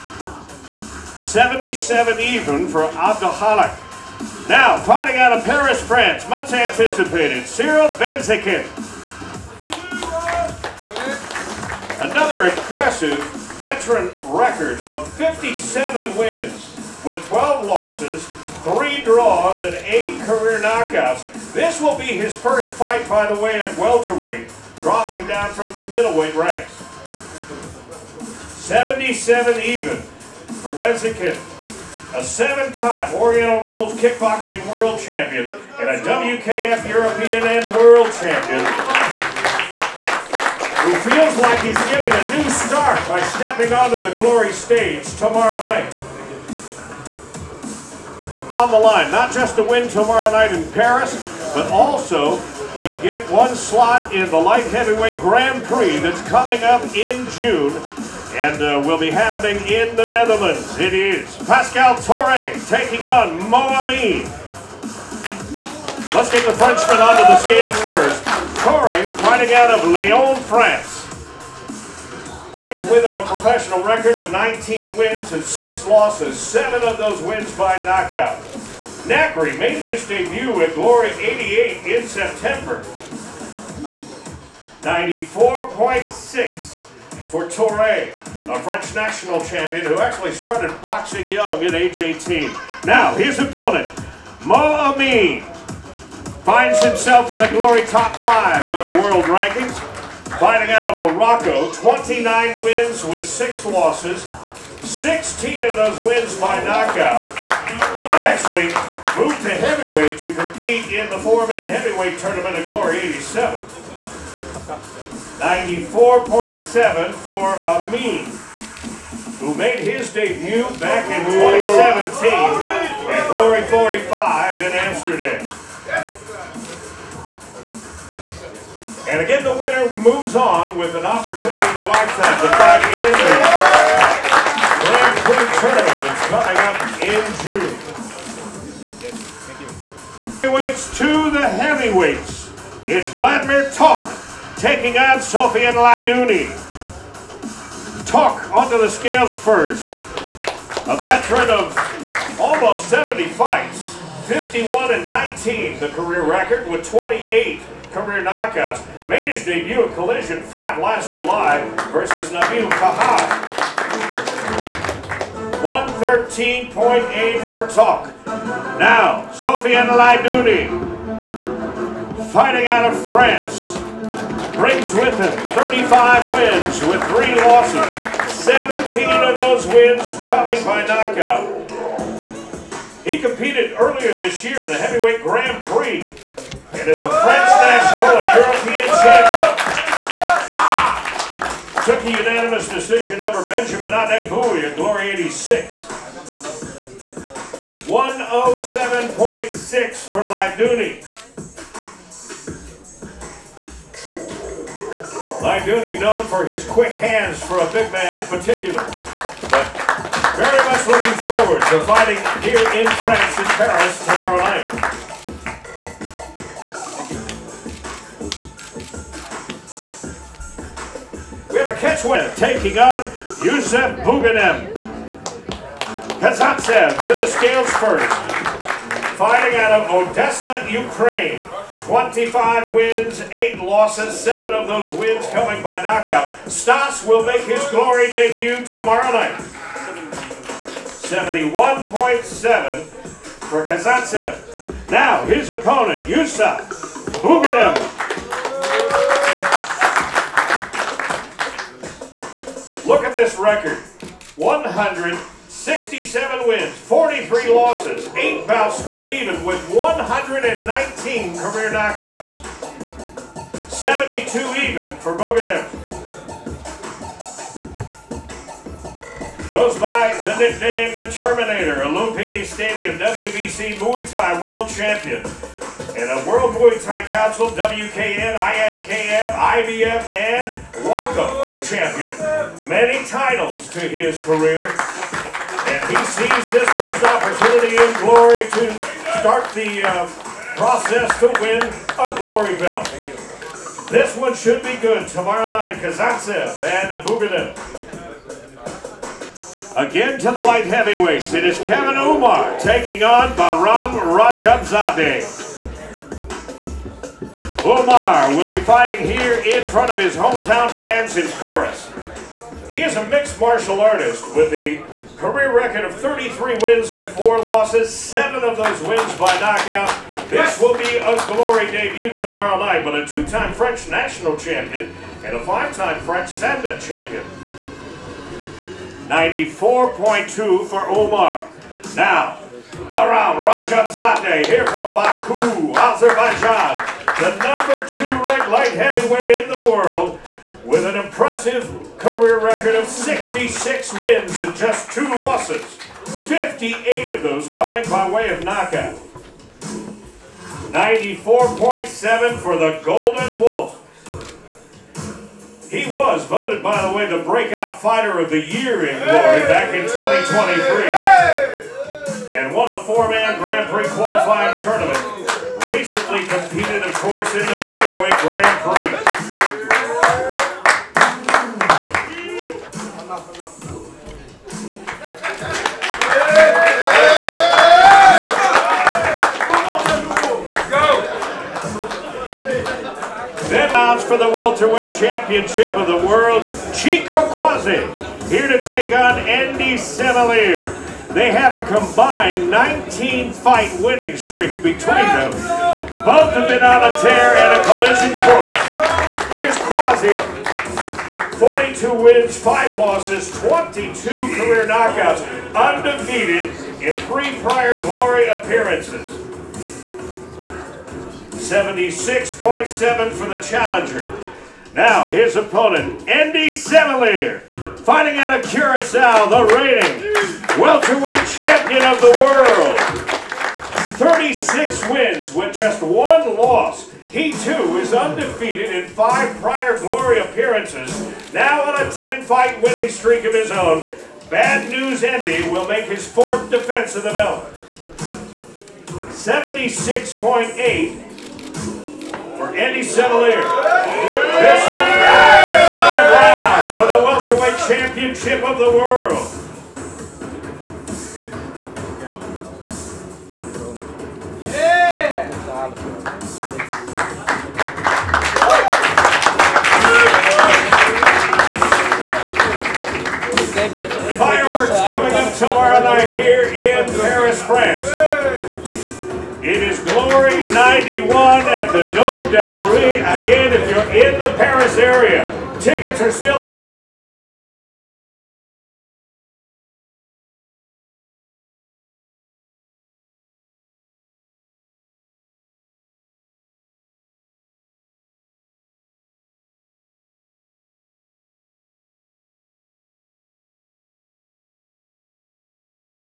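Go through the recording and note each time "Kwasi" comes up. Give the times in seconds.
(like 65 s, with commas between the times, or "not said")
387 s, 399 s.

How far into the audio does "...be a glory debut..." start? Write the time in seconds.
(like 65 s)
320 s.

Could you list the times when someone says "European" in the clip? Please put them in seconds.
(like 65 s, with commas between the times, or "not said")
36 s, 188 s.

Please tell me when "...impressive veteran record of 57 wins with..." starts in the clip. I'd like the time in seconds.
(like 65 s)
12 s.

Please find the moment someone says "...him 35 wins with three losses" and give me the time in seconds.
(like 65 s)
175 s.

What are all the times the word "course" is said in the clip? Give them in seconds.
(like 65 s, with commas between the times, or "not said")
366 s, 398 s.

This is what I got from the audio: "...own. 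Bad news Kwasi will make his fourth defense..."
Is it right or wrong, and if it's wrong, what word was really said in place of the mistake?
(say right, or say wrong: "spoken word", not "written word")
wrong: "Andy", not "Kwasi".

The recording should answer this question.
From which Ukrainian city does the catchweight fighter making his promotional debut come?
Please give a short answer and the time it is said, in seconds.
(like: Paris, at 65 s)
Odessa, at 230 s.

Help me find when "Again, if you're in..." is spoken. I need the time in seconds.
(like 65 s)
473 s.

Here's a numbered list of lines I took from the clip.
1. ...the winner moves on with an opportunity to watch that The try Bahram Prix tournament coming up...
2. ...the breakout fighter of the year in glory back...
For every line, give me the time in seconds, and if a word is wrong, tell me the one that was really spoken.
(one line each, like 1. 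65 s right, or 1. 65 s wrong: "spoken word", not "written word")
1. 129 s wrong: "Grand", not "Bahram"
2. 357 s right.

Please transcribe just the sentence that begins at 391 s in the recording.
They have a combined 19-fight winning streak between them.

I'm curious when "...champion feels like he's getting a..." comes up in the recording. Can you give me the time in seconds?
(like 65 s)
38 s.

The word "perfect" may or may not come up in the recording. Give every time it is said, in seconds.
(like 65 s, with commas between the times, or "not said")
not said.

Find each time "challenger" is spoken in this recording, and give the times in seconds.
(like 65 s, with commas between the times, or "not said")
413 s.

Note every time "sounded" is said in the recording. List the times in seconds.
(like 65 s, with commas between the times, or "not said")
not said.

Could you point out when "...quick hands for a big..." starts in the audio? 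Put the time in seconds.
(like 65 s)
206 s.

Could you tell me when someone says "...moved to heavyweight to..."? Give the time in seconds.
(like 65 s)
109 s.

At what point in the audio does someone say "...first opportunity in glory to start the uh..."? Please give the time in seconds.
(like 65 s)
286 s.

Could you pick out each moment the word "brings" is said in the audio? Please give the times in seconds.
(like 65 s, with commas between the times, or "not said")
72 s, 174 s.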